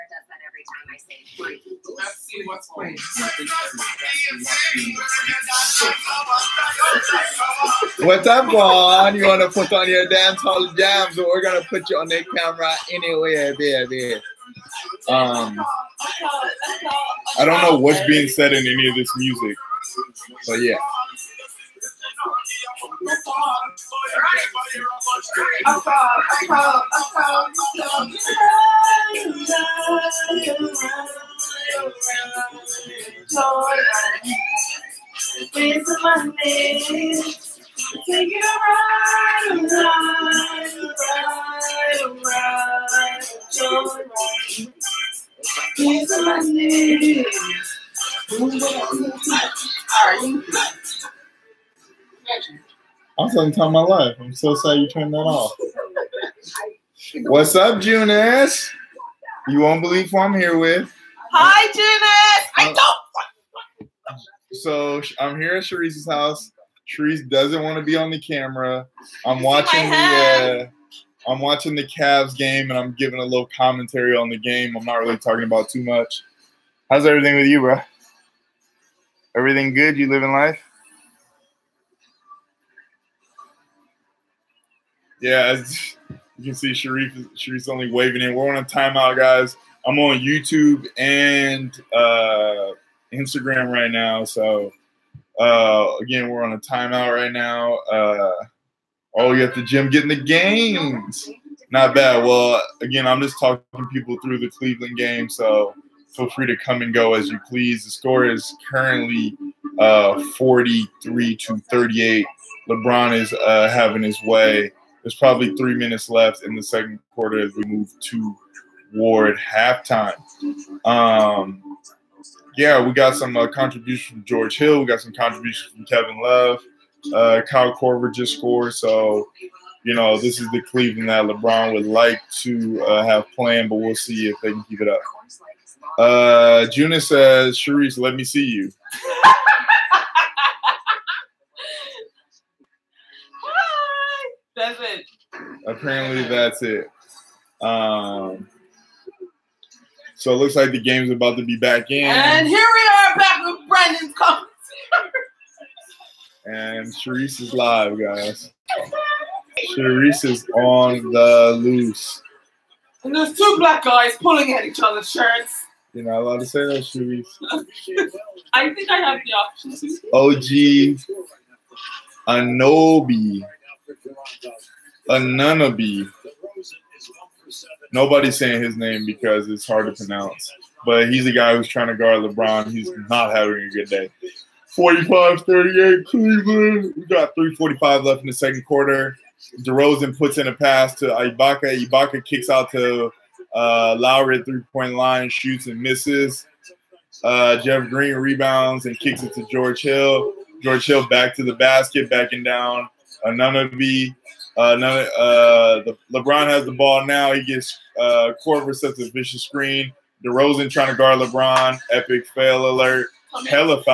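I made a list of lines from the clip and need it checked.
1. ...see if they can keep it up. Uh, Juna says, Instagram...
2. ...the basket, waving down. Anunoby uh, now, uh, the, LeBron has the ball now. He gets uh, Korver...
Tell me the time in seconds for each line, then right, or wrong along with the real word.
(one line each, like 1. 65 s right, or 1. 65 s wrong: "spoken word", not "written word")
1. 133 s wrong: "Sharice", not "Instagram"
2. 201 s wrong: "backing", not "waving".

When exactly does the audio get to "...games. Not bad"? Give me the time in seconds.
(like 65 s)
100 s.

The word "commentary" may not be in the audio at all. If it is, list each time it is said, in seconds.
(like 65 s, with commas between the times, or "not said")
73 s, 154 s.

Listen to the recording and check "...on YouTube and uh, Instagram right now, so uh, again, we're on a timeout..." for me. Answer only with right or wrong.
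right.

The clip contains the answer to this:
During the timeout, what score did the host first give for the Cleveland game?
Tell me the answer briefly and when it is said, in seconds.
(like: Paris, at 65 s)
43 to 38, at 110 s.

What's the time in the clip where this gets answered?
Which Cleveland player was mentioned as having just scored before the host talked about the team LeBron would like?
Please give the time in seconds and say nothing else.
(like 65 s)
127 s.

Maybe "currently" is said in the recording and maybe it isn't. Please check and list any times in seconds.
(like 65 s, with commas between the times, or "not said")
108 s.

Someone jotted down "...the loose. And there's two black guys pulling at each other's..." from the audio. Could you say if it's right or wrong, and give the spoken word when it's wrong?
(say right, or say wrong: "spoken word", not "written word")
right.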